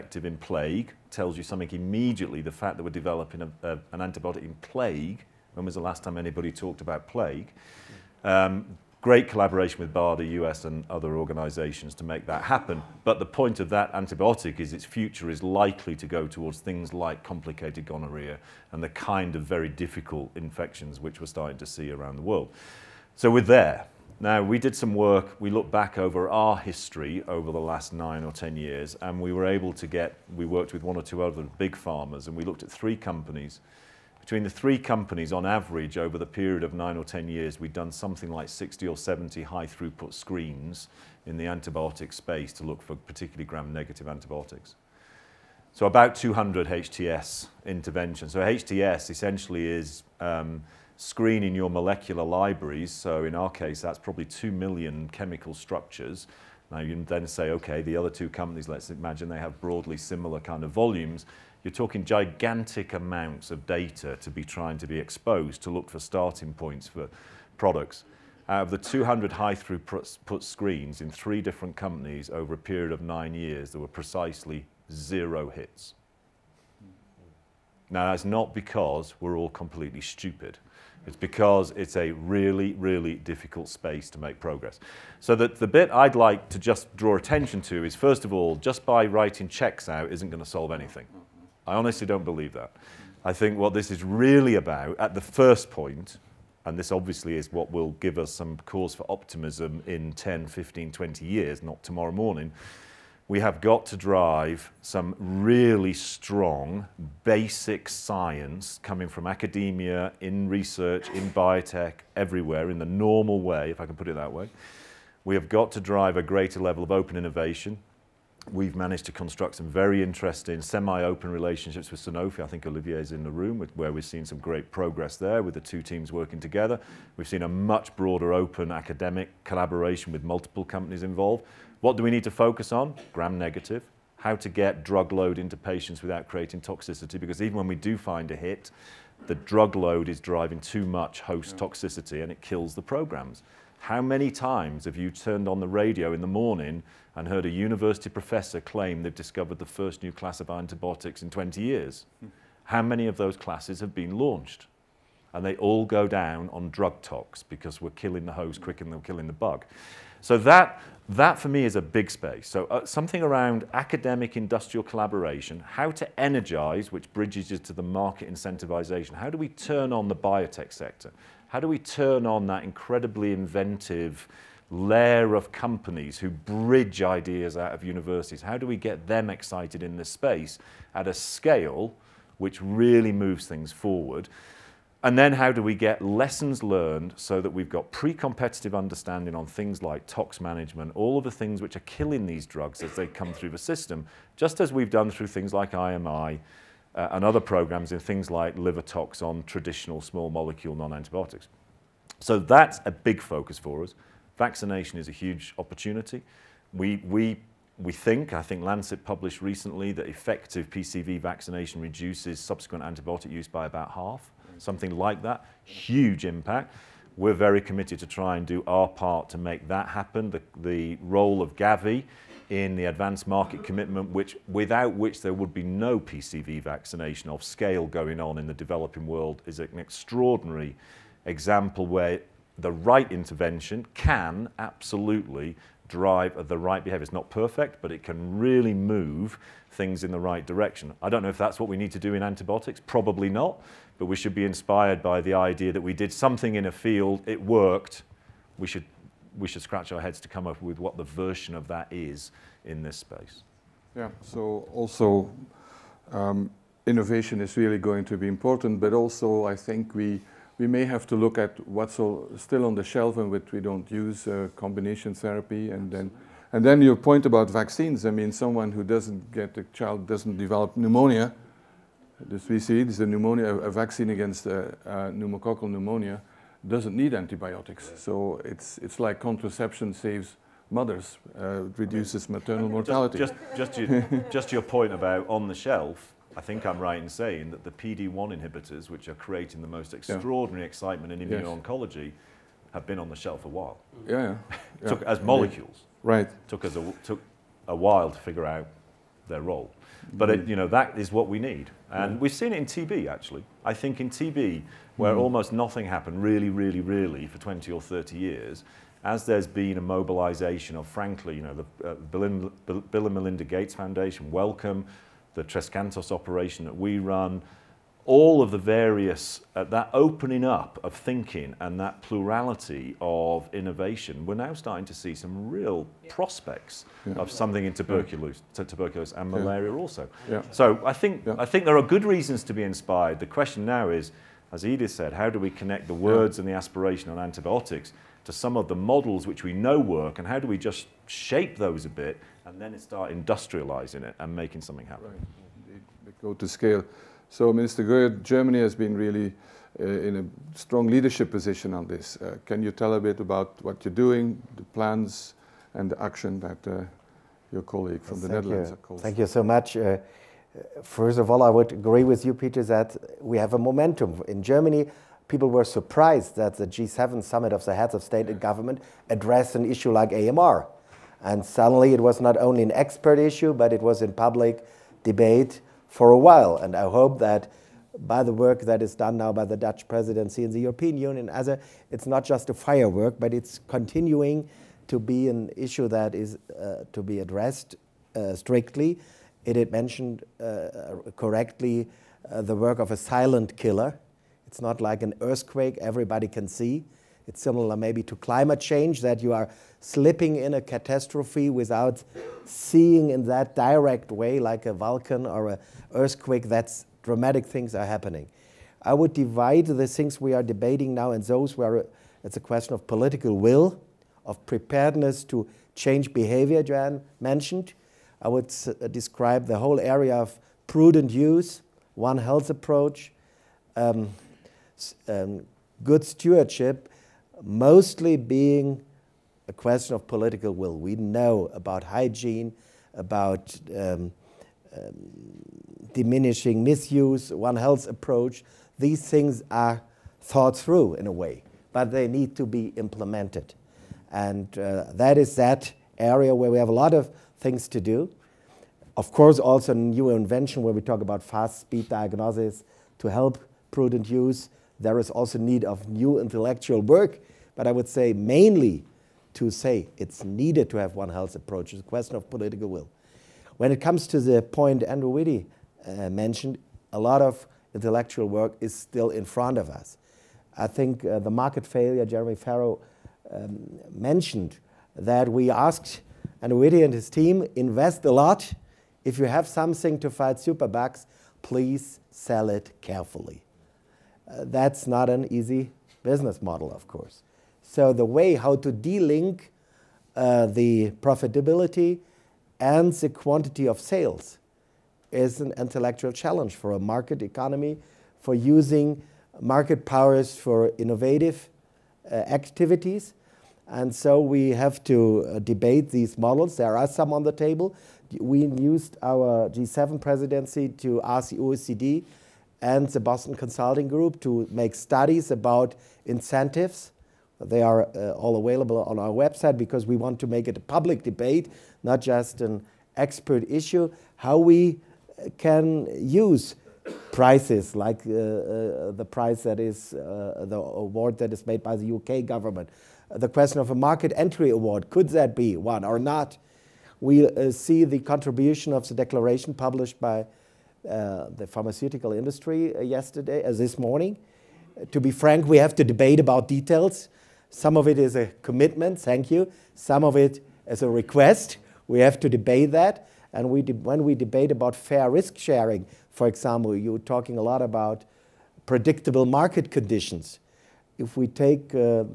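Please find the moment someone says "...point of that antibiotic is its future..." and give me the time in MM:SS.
00:13.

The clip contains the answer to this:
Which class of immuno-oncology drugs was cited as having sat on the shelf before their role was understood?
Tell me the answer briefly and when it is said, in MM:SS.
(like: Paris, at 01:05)
PD-1 inhibitors, at 04:47.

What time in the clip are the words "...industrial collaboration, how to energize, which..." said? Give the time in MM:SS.
02:44.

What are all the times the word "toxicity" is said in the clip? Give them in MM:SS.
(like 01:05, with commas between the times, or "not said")
02:16, 02:21.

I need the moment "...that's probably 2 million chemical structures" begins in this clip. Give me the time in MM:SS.
00:53.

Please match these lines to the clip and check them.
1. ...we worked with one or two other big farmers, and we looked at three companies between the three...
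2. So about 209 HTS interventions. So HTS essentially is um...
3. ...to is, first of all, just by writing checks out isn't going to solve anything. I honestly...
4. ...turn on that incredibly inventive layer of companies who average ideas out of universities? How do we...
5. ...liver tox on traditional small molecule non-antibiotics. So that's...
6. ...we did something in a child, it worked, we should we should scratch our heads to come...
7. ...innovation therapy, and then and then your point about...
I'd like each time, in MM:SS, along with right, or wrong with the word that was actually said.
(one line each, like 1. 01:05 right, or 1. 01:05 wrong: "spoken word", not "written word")
1. 00:30 right
2. 00:45 wrong: "200", not "209"
3. 01:27 right
4. 02:51 wrong: "bridge", not "average"
5. 03:18 right
6. 04:05 wrong: "field", not "child"
7. 04:24 wrong: "combination", not "innovation".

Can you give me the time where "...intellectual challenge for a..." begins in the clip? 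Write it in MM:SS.
08:15.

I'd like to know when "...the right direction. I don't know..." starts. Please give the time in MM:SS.
04:00.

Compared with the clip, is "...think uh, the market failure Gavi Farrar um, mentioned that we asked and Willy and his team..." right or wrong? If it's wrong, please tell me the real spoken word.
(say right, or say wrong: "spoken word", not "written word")
wrong: "Jeremy", not "Gavi".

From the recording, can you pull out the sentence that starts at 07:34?
There is also need of new intellectual work, but I would say mainly to say it's needed to have one health approach.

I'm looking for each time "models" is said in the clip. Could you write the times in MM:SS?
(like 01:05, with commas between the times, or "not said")
05:38, 08:06, 08:26.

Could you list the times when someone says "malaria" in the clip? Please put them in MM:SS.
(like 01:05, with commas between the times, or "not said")
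05:29.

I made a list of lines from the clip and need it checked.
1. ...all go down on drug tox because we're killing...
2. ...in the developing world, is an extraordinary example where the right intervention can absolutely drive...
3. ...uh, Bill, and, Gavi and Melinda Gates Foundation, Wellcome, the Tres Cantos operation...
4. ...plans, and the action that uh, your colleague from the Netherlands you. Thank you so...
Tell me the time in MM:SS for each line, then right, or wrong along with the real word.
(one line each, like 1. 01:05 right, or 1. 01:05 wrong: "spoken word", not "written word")
1. 02:35 right
2. 03:48 right
3. 05:11 wrong: "Bill", not "Gavi"
4. 05:54 right.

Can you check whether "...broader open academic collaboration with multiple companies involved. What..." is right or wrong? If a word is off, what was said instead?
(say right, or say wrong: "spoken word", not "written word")
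right.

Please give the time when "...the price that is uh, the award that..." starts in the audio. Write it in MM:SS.
08:48.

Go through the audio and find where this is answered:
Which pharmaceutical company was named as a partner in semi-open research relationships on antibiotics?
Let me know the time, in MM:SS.
02:01.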